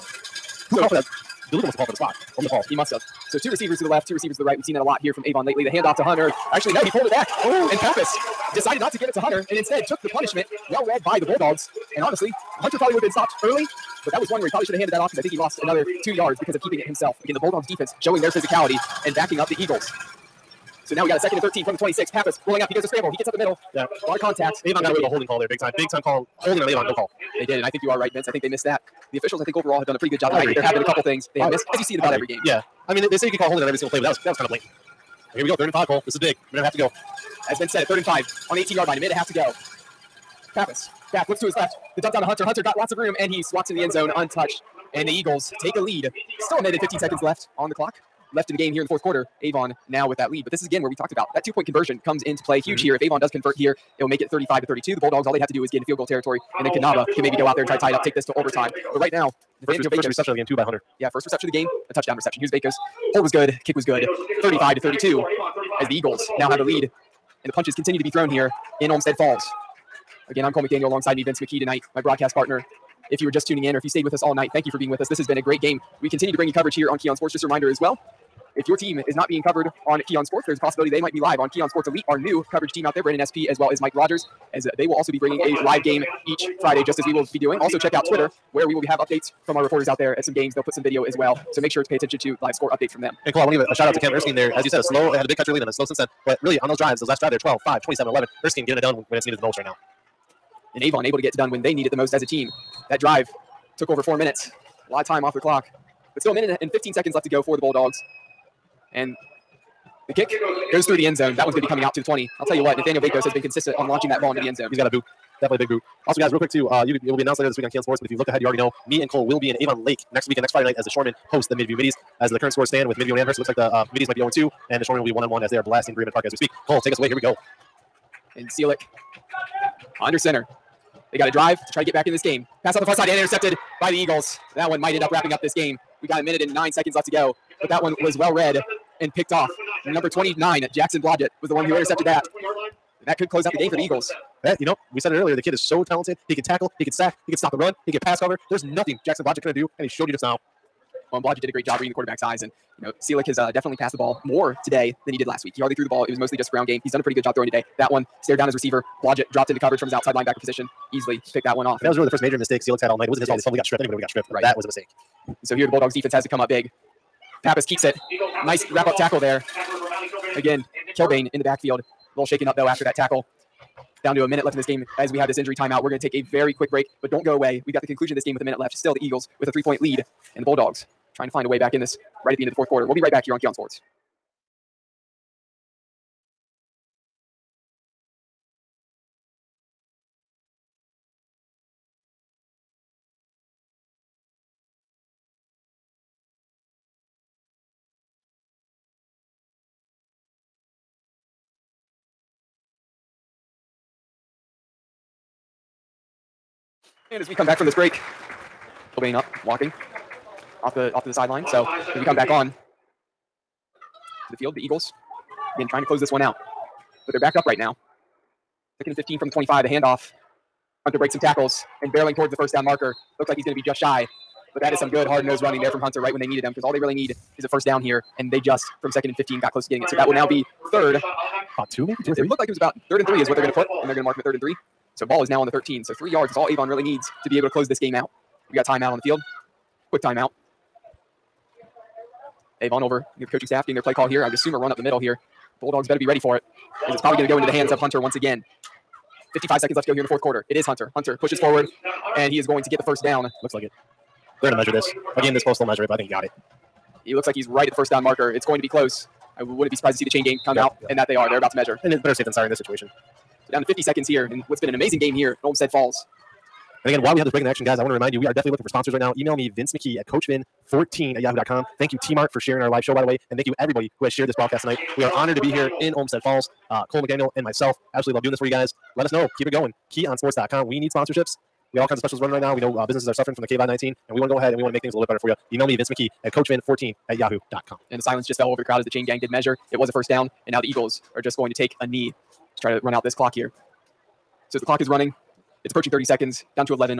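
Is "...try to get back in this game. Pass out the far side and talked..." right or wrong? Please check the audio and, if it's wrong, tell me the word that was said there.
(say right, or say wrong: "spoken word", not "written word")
wrong: "intercepted", not "talked".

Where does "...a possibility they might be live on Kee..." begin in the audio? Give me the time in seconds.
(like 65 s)
80 s.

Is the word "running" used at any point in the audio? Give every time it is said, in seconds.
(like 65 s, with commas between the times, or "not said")
225 s, 282 s, 294 s.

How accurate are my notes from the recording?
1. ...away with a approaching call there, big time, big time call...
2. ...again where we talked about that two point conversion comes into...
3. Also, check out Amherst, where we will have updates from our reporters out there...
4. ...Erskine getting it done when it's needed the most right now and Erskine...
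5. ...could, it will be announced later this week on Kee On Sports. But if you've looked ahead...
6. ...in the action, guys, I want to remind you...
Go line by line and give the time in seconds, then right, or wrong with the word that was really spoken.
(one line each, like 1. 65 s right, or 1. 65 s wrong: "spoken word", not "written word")
1. 24 s wrong: "holding", not "approaching"
2. 50 s right
3. 87 s wrong: "Twitter", not "Amherst"
4. 98 s wrong: "Avon", not "Erskine"
5. 116 s right
6. 267 s right.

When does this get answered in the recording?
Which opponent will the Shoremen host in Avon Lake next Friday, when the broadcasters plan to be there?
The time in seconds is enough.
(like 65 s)
121 s.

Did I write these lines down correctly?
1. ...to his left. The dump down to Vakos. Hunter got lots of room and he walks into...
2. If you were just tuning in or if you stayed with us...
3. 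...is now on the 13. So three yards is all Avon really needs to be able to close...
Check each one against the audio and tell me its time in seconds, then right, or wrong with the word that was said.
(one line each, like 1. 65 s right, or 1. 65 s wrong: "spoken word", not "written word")
1. 41 s wrong: "Hunter", not "Vakos"
2. 73 s right
3. 235 s right.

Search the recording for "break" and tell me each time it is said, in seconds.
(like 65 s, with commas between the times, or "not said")
176 s, 207 s, 220 s, 267 s.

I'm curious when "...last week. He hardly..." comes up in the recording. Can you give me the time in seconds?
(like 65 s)
155 s.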